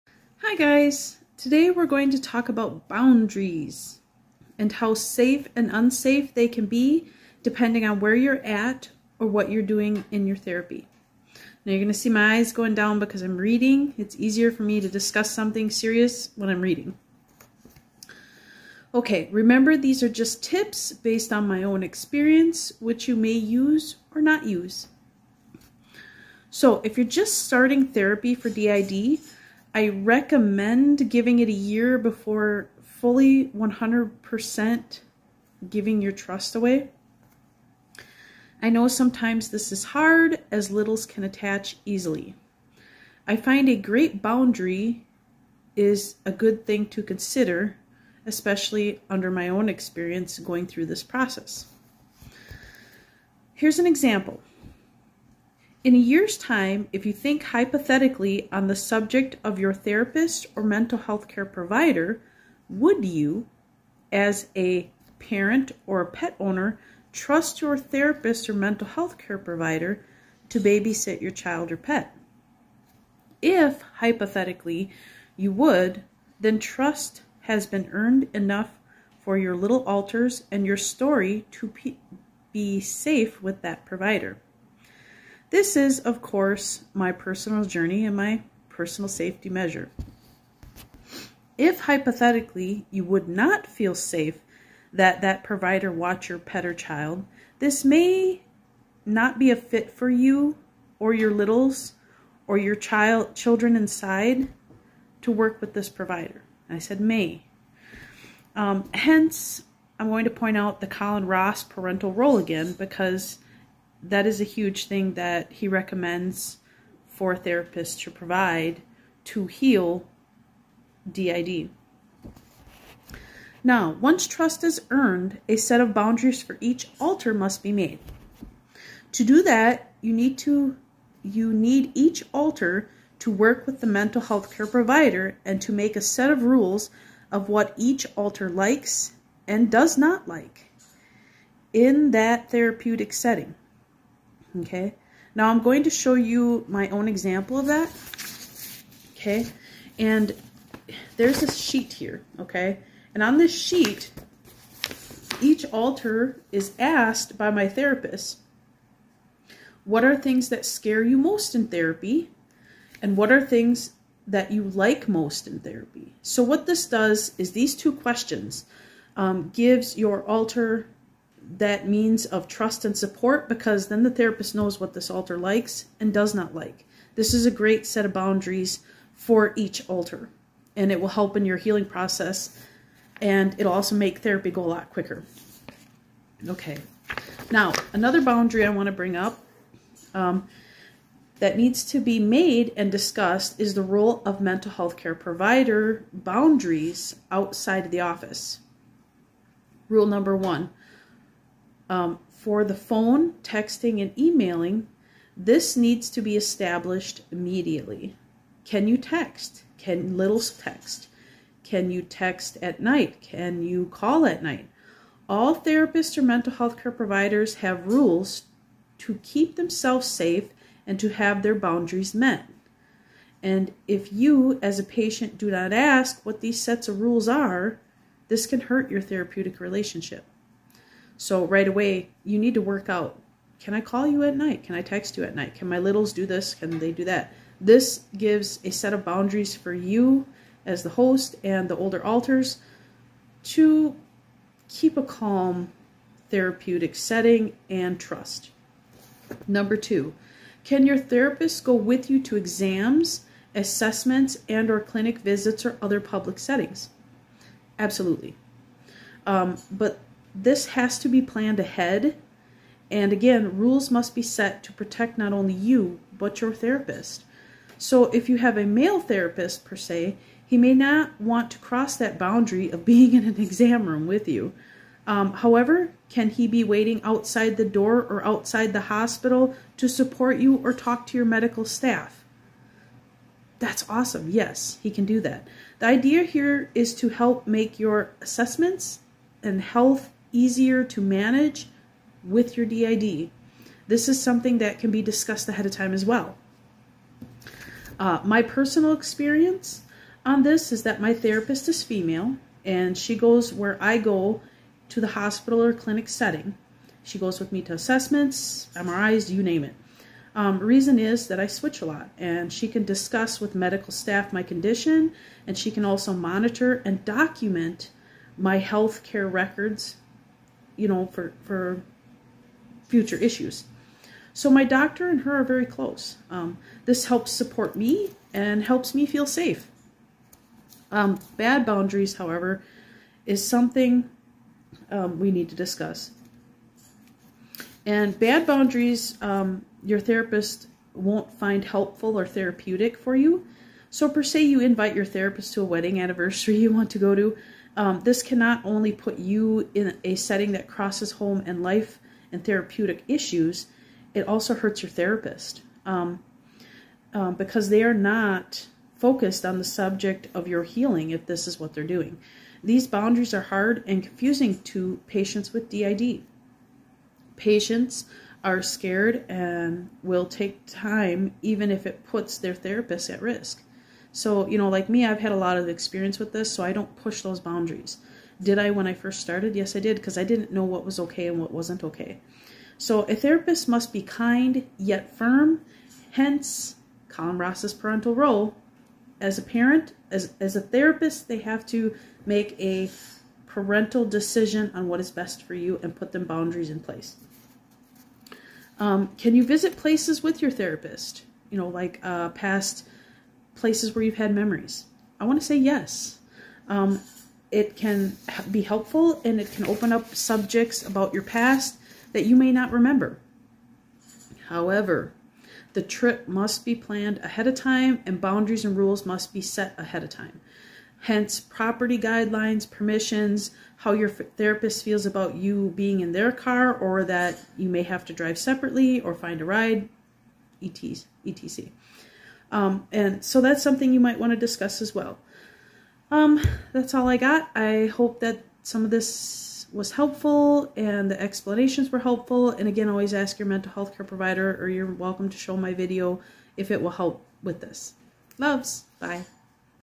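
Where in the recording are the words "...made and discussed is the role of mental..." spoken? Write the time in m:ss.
3:12.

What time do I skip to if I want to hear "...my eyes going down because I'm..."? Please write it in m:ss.
0:12.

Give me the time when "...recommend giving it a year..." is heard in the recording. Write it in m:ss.
0:29.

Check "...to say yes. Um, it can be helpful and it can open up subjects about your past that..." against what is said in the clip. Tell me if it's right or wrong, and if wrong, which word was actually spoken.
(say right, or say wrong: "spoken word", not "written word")
right.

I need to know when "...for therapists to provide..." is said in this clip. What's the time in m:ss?
1:57.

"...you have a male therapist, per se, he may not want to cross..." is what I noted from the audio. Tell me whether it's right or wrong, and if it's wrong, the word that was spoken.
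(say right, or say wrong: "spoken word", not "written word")
right.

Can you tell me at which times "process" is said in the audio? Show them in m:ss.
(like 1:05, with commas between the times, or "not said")
0:51, 3:01.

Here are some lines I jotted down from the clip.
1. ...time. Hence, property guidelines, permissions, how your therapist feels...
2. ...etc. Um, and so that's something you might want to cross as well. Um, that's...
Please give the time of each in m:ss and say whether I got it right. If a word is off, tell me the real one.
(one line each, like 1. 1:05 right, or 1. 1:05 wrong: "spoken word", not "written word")
1. 7:00 right
2. 7:11 wrong: "discuss", not "cross".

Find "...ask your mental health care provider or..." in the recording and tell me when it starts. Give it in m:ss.
7:23.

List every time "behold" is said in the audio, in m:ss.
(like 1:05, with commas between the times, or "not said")
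not said.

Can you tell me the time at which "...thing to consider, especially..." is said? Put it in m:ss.
0:46.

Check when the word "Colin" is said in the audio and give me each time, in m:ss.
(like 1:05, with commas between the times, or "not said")
1:50, 6:27.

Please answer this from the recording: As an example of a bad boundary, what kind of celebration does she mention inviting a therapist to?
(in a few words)
wedding anniversary.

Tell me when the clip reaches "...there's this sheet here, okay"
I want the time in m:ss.
2:31.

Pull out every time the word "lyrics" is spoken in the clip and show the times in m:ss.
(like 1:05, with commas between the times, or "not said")
not said.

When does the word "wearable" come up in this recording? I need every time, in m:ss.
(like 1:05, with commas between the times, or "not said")
not said.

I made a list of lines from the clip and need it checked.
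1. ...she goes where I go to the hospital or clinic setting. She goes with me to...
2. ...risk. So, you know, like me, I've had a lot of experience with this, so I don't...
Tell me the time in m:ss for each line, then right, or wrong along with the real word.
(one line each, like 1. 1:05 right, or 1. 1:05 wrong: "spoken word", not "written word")
1. 5:02 right
2. 6:13 right.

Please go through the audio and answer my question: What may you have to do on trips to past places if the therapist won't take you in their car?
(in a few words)
drive separately.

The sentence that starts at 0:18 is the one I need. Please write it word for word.
Okay, remember these are just tips based on my own experience, which you may use or not use.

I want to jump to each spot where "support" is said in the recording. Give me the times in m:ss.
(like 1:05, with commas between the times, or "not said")
2:52, 4:39, 5:27.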